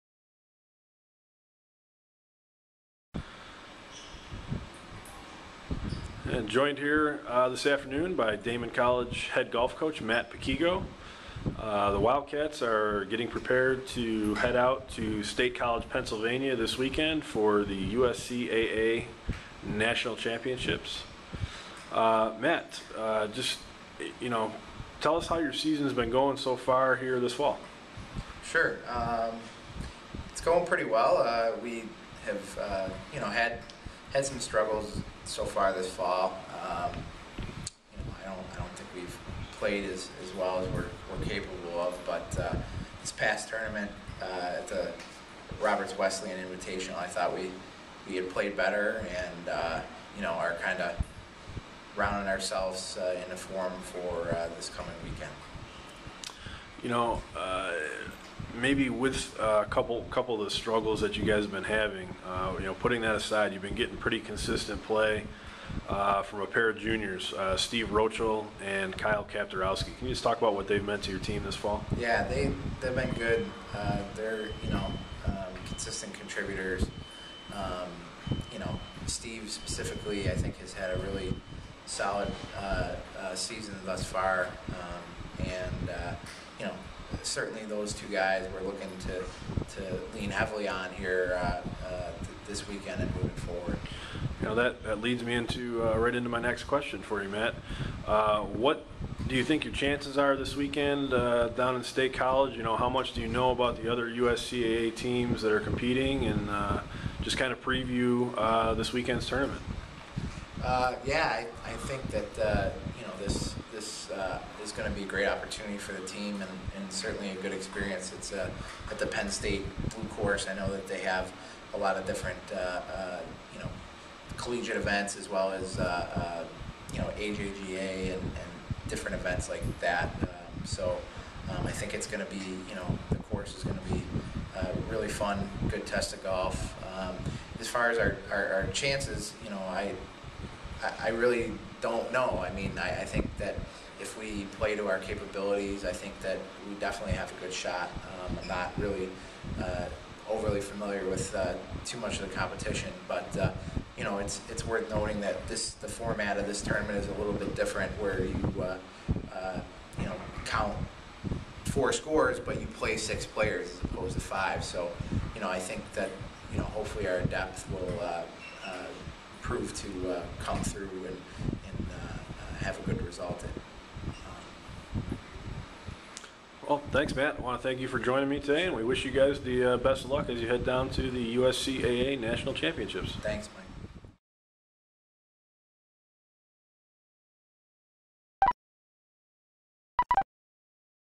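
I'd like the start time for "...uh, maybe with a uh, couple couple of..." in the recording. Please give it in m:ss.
0:57.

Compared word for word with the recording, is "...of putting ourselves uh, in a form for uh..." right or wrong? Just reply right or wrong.
wrong.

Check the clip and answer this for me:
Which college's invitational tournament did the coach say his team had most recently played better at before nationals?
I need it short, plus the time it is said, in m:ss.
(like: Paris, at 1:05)
Roberts Wesleyan, at 0:45.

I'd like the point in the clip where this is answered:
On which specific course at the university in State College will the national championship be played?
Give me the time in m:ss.
1:59.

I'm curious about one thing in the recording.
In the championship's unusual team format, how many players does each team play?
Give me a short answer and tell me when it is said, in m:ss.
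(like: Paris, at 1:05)
6, at 2:42.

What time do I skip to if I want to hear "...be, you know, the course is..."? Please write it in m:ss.
2:12.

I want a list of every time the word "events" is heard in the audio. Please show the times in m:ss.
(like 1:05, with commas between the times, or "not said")
2:04, 2:09.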